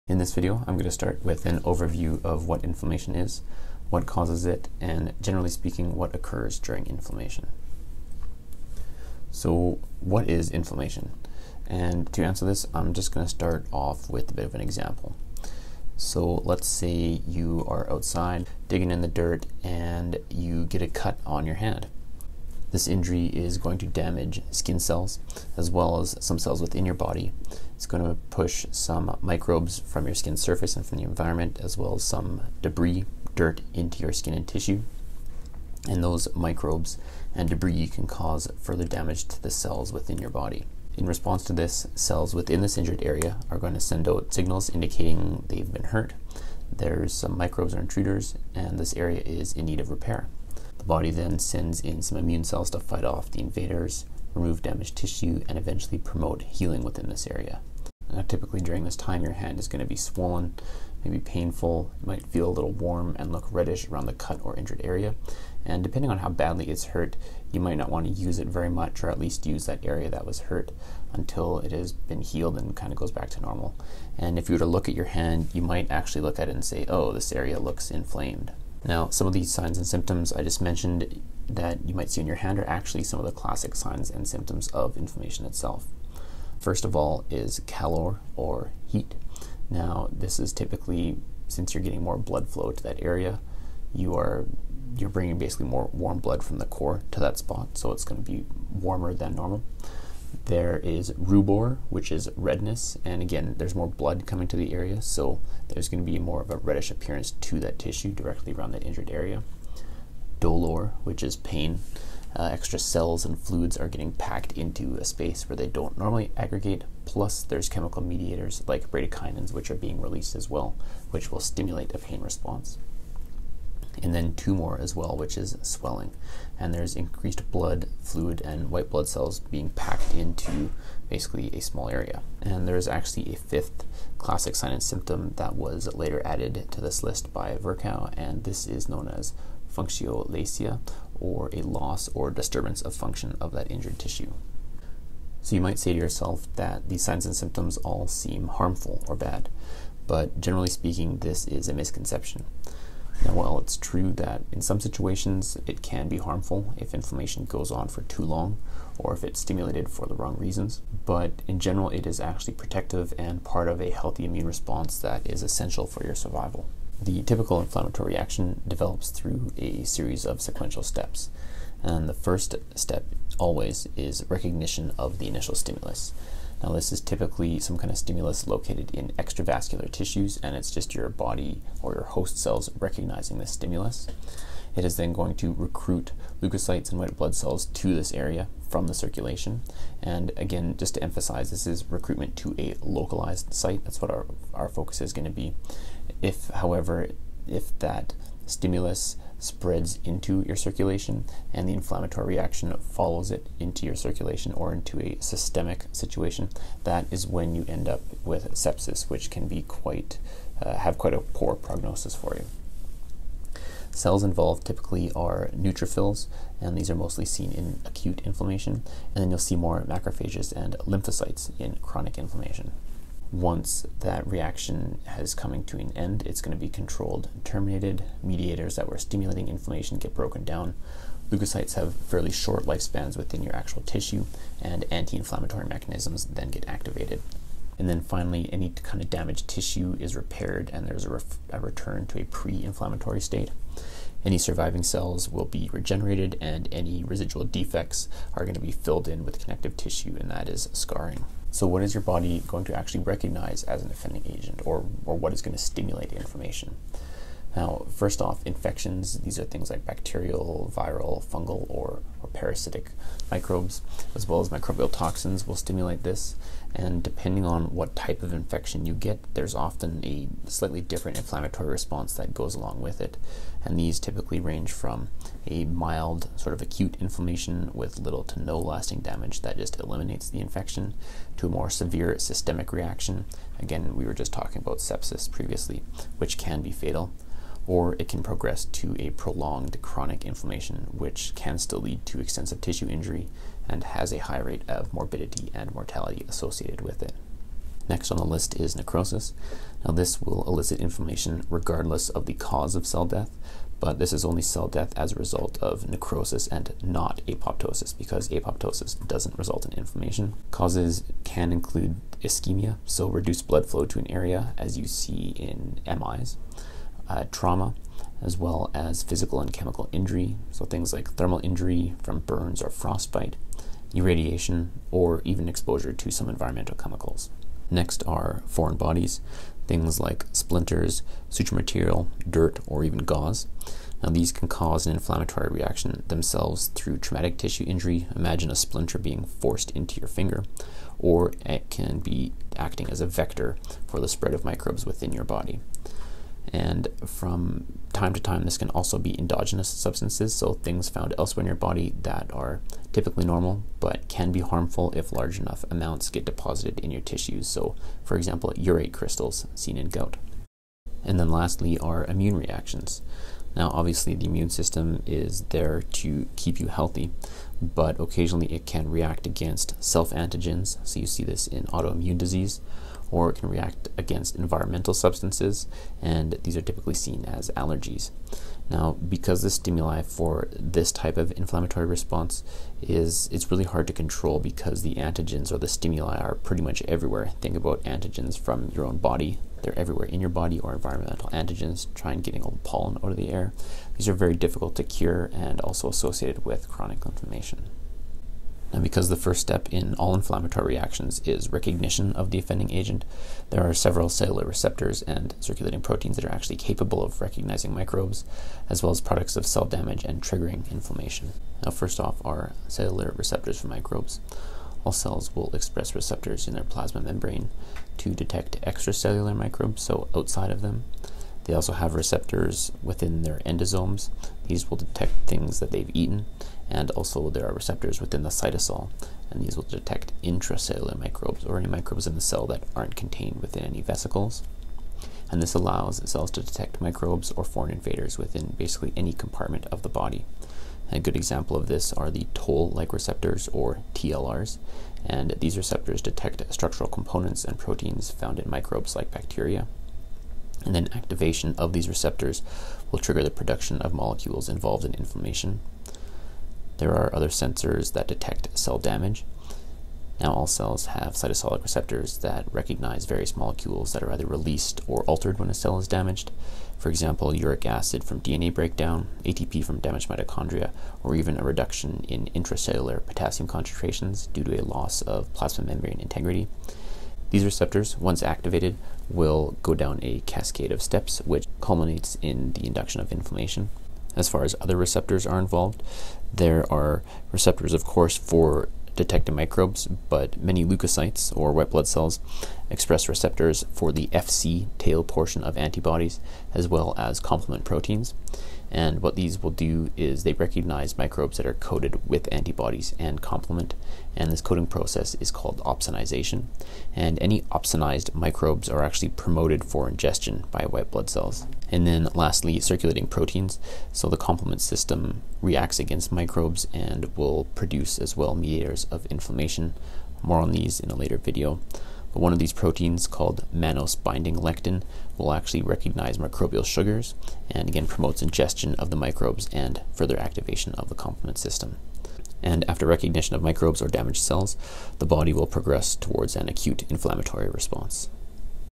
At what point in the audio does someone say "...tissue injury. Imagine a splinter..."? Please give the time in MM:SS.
05:37.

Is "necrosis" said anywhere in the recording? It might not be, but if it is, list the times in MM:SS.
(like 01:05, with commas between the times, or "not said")
04:58, 05:05.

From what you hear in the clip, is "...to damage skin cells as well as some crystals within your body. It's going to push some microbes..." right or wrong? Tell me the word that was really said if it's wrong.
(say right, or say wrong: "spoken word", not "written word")
wrong: "cells", not "crystals".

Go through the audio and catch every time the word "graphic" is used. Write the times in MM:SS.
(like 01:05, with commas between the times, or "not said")
not said.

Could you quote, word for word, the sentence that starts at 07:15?
And this allows cells to detect microbes or foreign invaders within basically any compartment of the body.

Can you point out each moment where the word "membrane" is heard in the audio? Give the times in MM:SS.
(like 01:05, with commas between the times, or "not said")
06:57, 07:55.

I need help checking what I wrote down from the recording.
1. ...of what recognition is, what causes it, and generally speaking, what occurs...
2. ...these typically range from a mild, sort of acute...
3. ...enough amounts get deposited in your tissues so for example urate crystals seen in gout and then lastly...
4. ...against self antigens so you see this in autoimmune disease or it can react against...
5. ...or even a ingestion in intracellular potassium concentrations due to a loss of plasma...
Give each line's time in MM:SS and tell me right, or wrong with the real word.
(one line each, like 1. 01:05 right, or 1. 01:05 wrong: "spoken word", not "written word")
1. 00:02 wrong: "inflammation", not "recognition"
2. 04:33 right
3. 05:55 right
4. 06:09 right
5. 07:51 wrong: "reduction", not "ingestion".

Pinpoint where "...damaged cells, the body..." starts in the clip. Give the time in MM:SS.
08:53.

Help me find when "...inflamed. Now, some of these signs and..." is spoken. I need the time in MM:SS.
01:17.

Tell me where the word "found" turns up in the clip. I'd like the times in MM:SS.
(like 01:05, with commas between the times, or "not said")
05:50, 07:28.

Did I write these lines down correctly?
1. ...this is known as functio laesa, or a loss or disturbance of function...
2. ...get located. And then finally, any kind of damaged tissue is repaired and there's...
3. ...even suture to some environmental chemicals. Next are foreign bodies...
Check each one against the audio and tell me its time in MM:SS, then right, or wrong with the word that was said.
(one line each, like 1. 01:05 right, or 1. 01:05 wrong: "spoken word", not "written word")
1. 02:18 right
2. 03:56 wrong: "activated", not "located"
3. 05:25 wrong: "exposure", not "suture".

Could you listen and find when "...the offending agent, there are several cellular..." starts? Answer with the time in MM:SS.
06:42.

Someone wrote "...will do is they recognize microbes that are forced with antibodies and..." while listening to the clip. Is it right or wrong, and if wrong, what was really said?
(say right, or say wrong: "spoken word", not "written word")
wrong: "coated", not "forced".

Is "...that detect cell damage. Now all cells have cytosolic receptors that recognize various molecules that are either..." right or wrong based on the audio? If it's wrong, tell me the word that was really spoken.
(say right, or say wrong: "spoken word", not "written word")
right.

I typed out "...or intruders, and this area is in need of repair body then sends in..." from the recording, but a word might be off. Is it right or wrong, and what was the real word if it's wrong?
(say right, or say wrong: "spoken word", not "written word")
right.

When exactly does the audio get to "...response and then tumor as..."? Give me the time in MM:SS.
02:02.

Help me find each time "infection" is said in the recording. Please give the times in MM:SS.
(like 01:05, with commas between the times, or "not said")
04:18, 04:28, 04:40.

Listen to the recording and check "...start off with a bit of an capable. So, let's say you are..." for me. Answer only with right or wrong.
wrong.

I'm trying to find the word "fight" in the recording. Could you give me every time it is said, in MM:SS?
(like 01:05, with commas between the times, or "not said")
00:52.